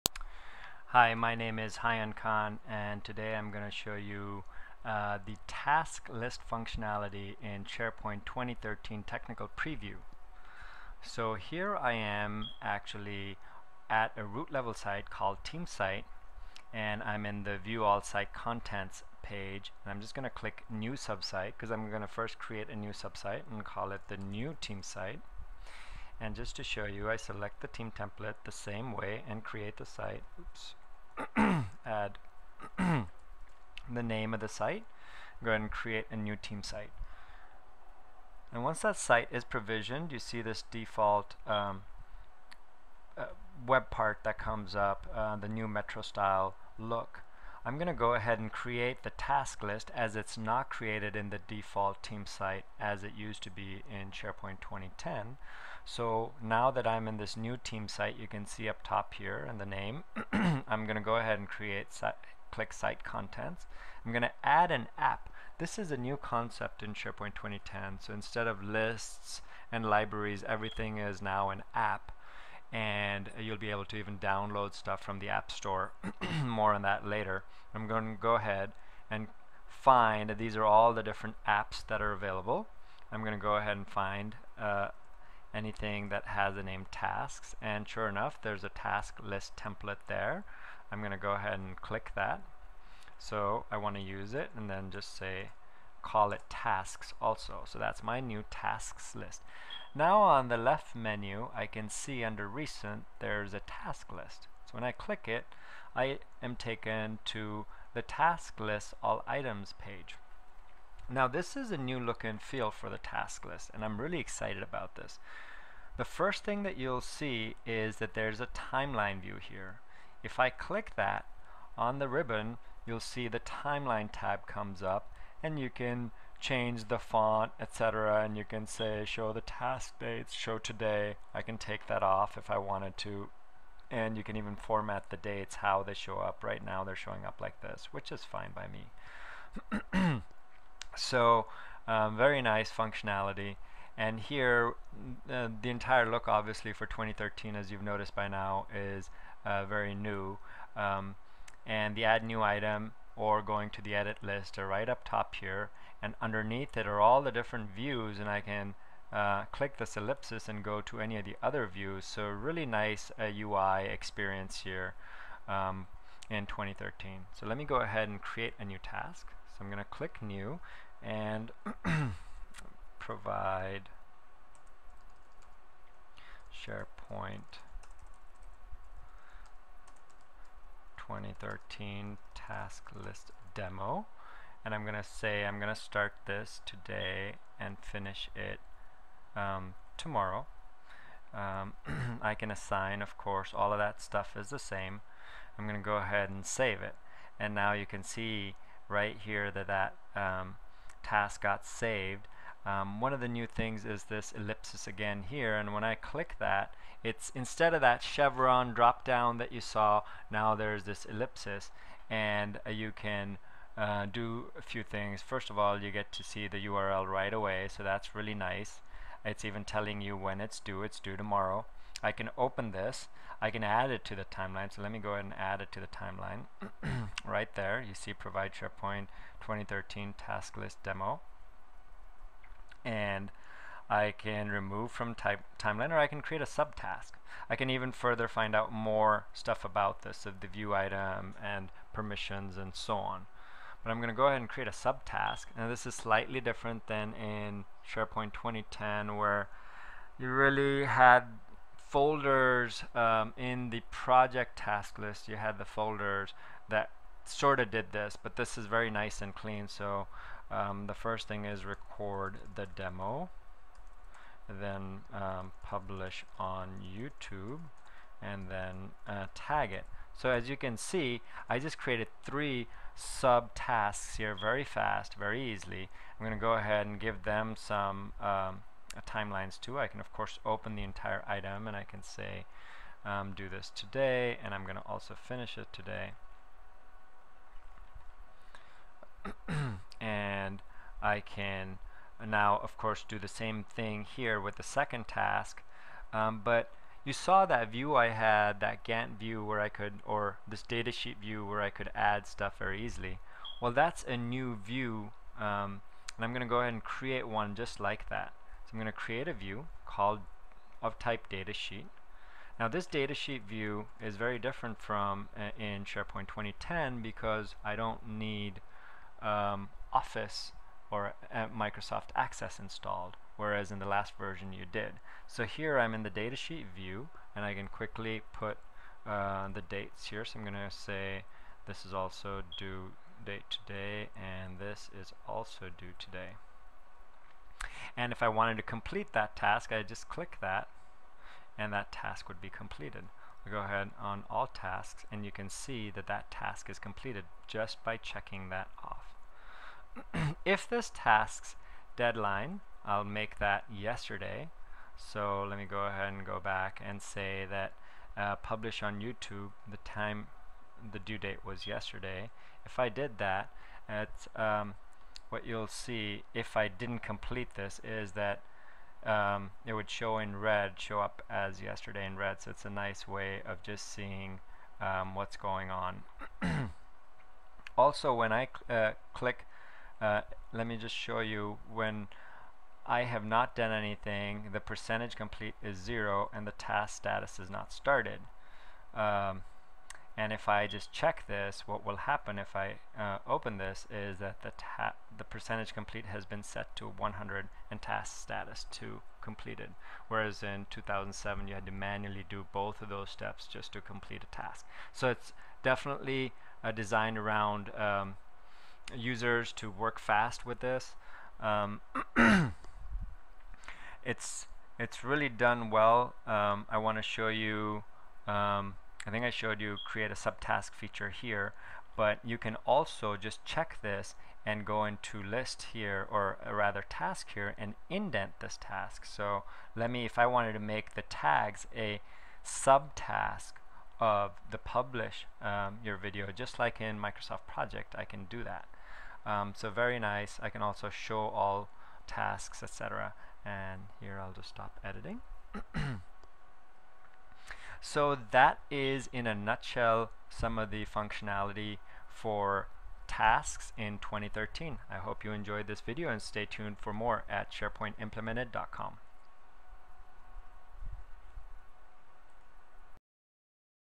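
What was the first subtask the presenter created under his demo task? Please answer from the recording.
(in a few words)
record the demo.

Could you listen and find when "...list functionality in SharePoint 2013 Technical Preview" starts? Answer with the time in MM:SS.
00:06.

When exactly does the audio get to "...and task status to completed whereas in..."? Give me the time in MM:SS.
06:37.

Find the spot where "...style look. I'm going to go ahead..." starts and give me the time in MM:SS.
00:46.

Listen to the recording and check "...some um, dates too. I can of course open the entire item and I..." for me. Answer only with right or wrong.
wrong.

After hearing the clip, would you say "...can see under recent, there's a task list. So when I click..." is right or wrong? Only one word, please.
right.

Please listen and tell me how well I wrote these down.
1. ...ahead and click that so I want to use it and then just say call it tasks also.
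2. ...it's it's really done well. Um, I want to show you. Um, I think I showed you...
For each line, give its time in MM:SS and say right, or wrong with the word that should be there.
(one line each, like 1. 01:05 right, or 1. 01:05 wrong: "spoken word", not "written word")
1. 01:31 right
2. 06:54 right.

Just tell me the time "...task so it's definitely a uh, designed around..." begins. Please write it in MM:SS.
06:44.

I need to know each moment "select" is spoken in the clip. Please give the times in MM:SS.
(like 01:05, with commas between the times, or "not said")
00:27.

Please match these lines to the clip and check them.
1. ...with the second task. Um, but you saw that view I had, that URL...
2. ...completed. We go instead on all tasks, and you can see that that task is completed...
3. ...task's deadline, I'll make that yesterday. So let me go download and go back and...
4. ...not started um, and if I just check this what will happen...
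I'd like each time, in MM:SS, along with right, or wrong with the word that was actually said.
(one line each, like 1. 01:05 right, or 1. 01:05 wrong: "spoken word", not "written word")
1. 04:54 wrong: "Gantt", not "URL"
2. 05:42 wrong: "ahead", not "instead"
3. 05:50 wrong: "ahead", not "download"
4. 06:27 right.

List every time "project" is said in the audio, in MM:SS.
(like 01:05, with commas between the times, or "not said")
04:13, 07:17.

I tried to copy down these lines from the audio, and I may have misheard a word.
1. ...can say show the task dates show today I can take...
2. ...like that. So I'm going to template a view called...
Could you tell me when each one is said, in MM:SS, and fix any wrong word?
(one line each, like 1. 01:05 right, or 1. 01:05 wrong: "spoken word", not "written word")
1. 02:08 right
2. 05:07 wrong: "create", not "template".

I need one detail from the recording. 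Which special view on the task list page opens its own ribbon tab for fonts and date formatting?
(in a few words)
timeline view.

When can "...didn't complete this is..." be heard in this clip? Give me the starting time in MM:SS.
06:06.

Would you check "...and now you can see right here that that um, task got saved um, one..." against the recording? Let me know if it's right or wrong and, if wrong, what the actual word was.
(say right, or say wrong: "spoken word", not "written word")
right.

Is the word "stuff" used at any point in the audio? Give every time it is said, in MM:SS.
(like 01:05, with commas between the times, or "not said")
01:14, 03:14, 03:59, 05:02.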